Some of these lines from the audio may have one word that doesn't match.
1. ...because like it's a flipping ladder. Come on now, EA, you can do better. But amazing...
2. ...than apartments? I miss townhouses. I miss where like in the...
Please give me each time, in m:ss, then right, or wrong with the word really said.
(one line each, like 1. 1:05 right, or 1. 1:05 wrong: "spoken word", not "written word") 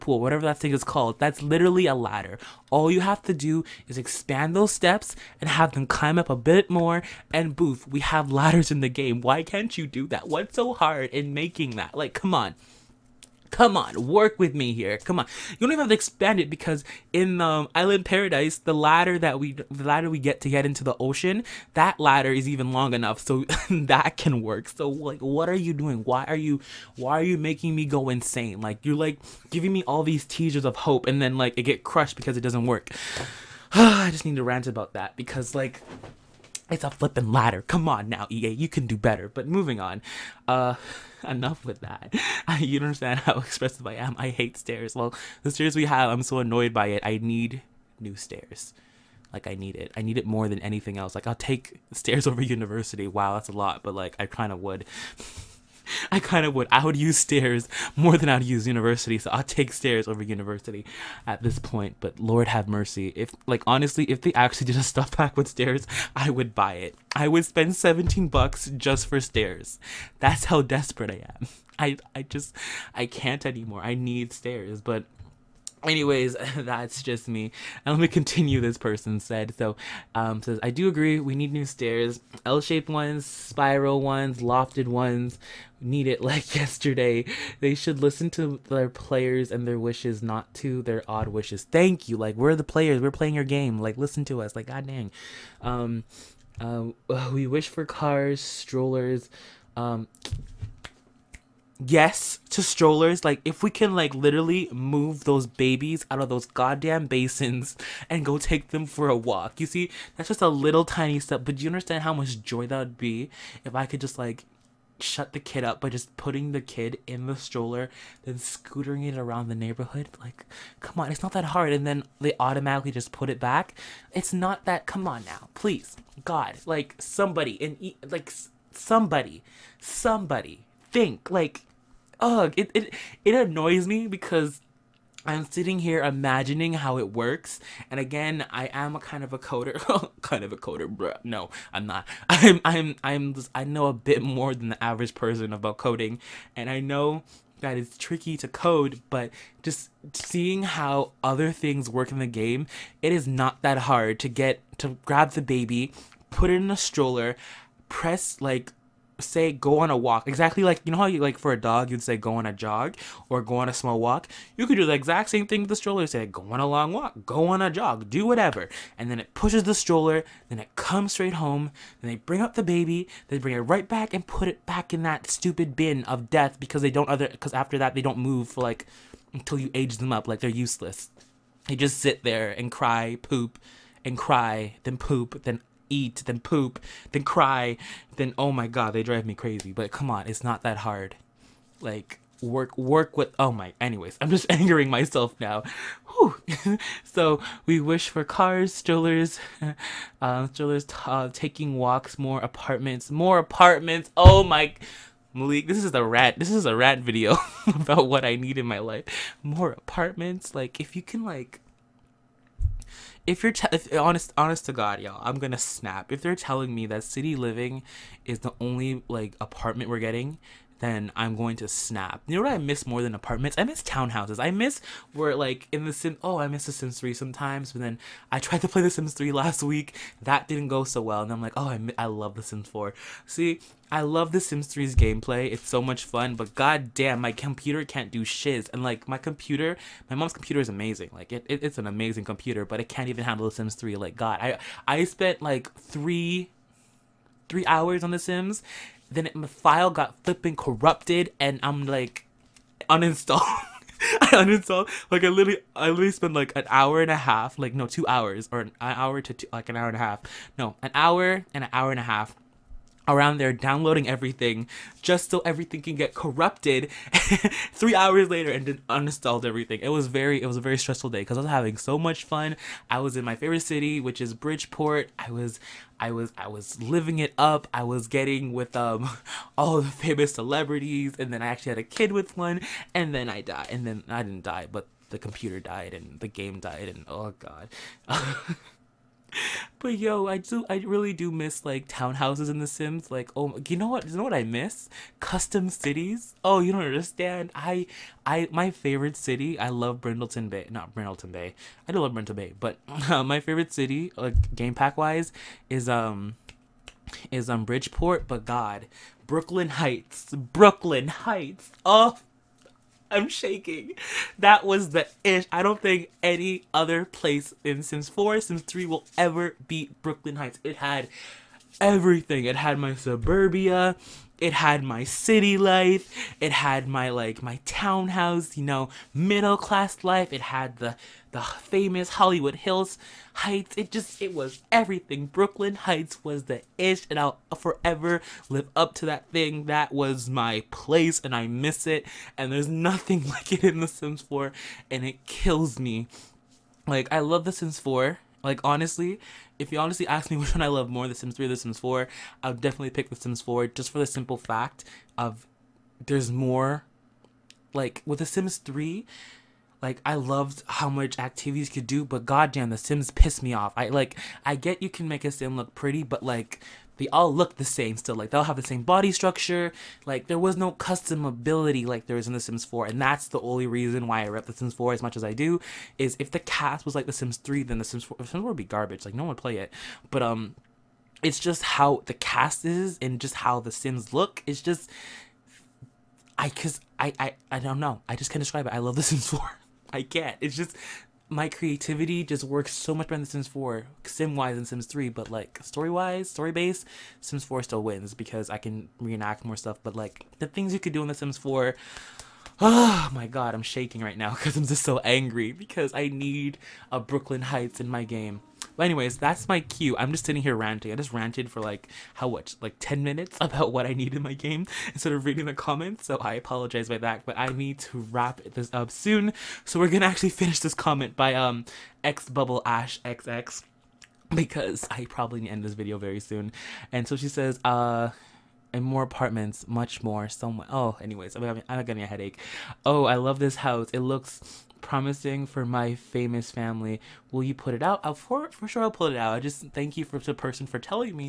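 1. 0:35 wrong: "moving", not "amazing"
2. 3:43 right.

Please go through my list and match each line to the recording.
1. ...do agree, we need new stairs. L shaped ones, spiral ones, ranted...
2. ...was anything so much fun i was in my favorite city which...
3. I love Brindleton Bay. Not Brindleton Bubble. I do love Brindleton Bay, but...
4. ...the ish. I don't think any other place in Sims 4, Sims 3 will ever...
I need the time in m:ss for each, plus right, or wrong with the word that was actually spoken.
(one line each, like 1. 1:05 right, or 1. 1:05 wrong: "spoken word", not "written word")
1. 1:20 wrong: "lofted", not "ranted"
2. 4:31 wrong: "having", not "anything"
3. 4:59 wrong: "Bay", not "Bubble"
4. 5:14 right.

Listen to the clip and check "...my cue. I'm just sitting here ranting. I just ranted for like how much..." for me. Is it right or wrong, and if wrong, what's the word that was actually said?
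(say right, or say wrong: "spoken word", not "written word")
right.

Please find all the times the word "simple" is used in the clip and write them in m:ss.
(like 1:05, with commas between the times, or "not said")
5:54.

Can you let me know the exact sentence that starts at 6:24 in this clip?
It's just, I, cause I, I, I don't know.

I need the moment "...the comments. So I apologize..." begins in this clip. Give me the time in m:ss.
6:55.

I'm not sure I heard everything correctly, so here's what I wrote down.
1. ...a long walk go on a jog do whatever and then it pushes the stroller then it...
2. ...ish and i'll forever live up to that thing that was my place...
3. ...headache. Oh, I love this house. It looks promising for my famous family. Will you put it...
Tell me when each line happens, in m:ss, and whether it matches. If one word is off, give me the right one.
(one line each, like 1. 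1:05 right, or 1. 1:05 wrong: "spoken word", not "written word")
1. 2:46 right
2. 5:36 right
3. 7:12 right.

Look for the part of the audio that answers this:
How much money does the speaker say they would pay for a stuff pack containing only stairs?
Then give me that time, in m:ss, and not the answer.
1:07.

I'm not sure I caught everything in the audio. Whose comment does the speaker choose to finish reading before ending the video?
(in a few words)
X Bubble Ash XX.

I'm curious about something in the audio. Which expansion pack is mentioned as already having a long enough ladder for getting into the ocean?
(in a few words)
Island Paradise.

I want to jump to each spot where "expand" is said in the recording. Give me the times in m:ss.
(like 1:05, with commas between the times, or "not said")
0:03, 0:15.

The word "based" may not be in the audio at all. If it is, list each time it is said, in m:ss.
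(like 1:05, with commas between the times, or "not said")
6:36.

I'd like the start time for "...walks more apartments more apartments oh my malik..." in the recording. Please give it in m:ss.
3:21.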